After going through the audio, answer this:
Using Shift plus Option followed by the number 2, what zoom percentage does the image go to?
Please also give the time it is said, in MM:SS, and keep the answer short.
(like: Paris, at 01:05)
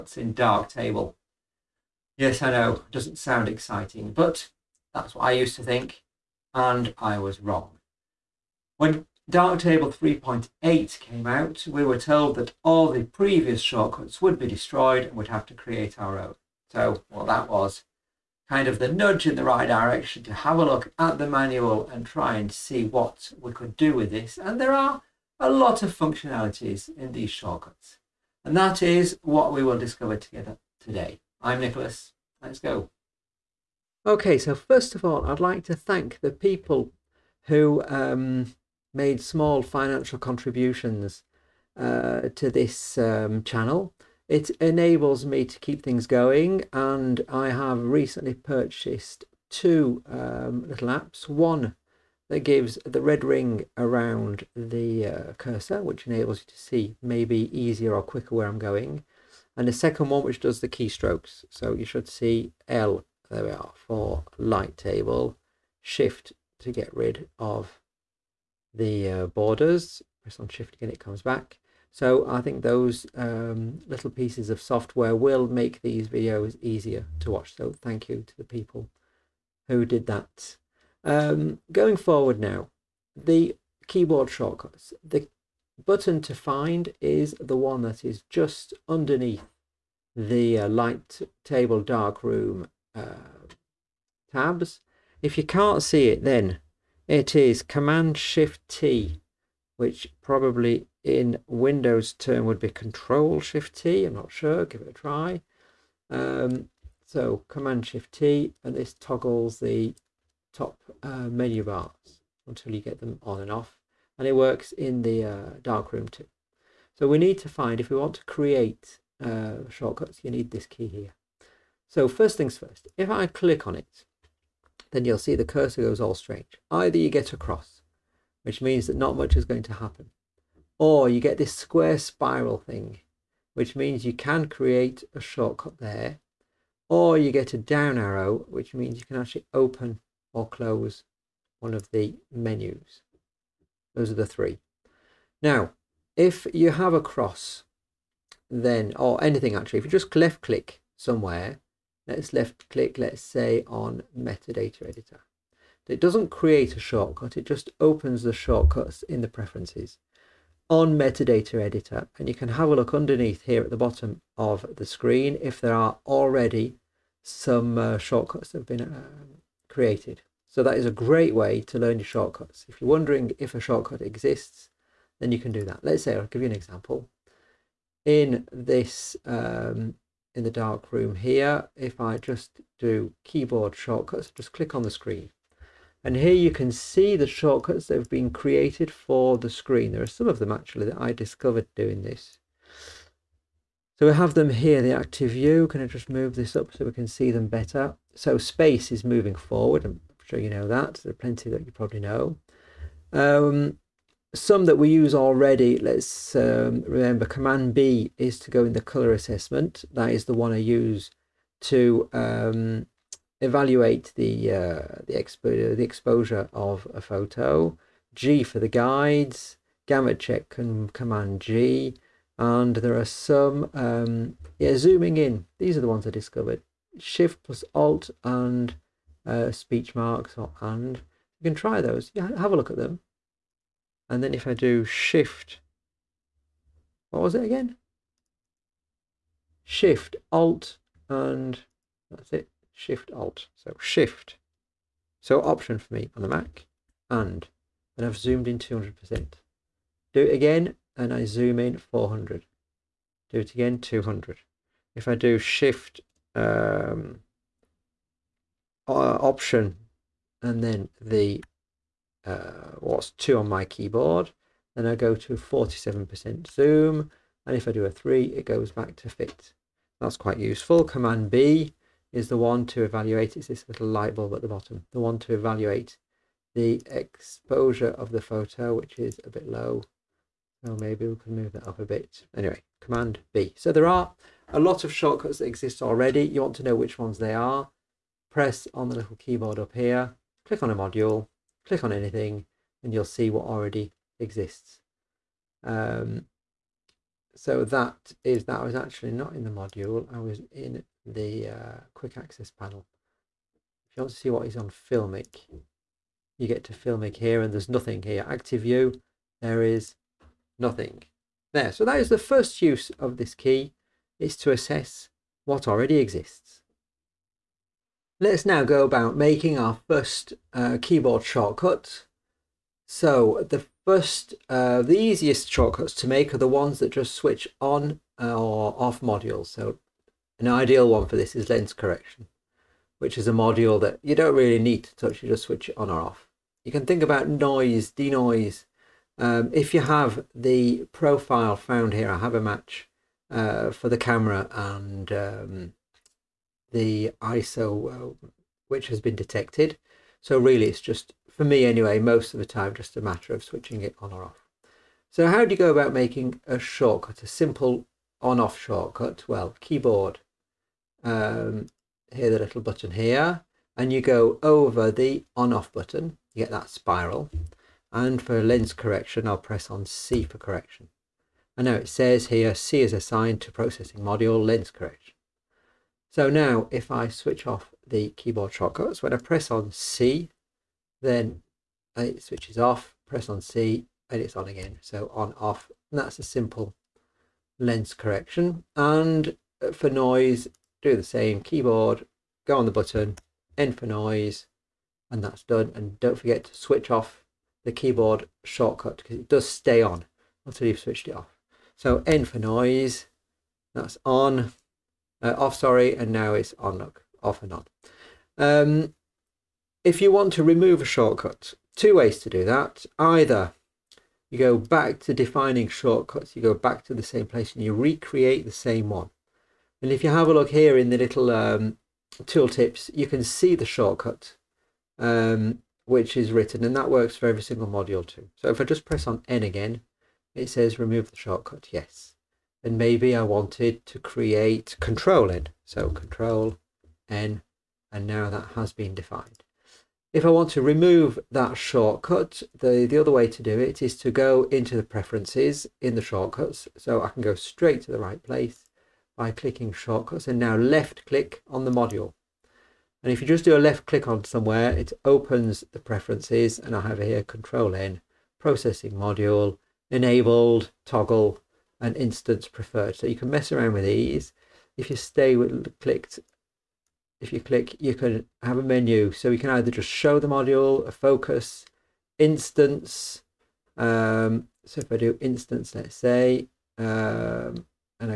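47%, at 04:25.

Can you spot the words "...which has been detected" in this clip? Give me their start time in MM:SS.
05:48.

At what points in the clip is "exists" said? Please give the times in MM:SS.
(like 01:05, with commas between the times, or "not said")
02:53, 04:45, 04:54, 05:15.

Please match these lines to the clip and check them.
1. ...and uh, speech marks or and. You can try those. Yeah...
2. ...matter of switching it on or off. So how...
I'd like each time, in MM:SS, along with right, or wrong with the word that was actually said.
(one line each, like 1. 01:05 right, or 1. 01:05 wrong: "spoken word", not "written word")
1. 03:48 right
2. 05:53 right.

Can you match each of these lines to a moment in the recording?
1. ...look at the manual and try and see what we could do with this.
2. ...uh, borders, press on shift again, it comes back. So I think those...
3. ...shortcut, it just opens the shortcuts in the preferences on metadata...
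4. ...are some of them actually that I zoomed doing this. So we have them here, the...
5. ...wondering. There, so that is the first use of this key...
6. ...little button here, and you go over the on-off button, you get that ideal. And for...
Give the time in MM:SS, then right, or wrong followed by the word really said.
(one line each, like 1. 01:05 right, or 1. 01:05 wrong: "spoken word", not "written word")
1. 00:20 right
2. 01:09 right
3. 02:36 right
4. 03:10 wrong: "discovered", not "zoomed"
5. 05:10 wrong: "nothing", not "wondering"
6. 06:02 wrong: "spiral", not "ideal".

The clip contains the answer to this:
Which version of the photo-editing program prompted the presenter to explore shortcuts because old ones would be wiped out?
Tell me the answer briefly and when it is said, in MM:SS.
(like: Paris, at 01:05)
3.8, at 00:09.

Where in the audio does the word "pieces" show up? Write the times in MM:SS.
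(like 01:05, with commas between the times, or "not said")
01:14.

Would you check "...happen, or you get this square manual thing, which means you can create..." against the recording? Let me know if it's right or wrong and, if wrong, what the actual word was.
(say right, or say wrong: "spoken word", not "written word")
wrong: "spiral", not "manual".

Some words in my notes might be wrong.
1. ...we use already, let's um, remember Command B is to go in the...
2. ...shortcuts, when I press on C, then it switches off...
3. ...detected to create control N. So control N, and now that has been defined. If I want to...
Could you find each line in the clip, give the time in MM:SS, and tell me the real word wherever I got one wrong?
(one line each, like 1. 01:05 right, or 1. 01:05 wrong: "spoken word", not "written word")
1. 03:24 right
2. 06:18 right
3. 07:13 wrong: "wanted", not "detected".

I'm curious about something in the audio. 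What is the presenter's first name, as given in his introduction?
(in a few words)
Nicholas.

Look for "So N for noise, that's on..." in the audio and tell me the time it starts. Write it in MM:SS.
06:41.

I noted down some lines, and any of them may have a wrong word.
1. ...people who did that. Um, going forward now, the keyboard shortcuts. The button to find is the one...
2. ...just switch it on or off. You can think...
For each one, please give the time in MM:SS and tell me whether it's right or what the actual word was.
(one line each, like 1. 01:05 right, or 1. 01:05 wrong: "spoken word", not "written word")
1. 01:18 right
2. 05:35 right.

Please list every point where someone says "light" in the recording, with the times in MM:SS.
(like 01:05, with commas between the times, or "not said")
01:04, 01:30, 04:33.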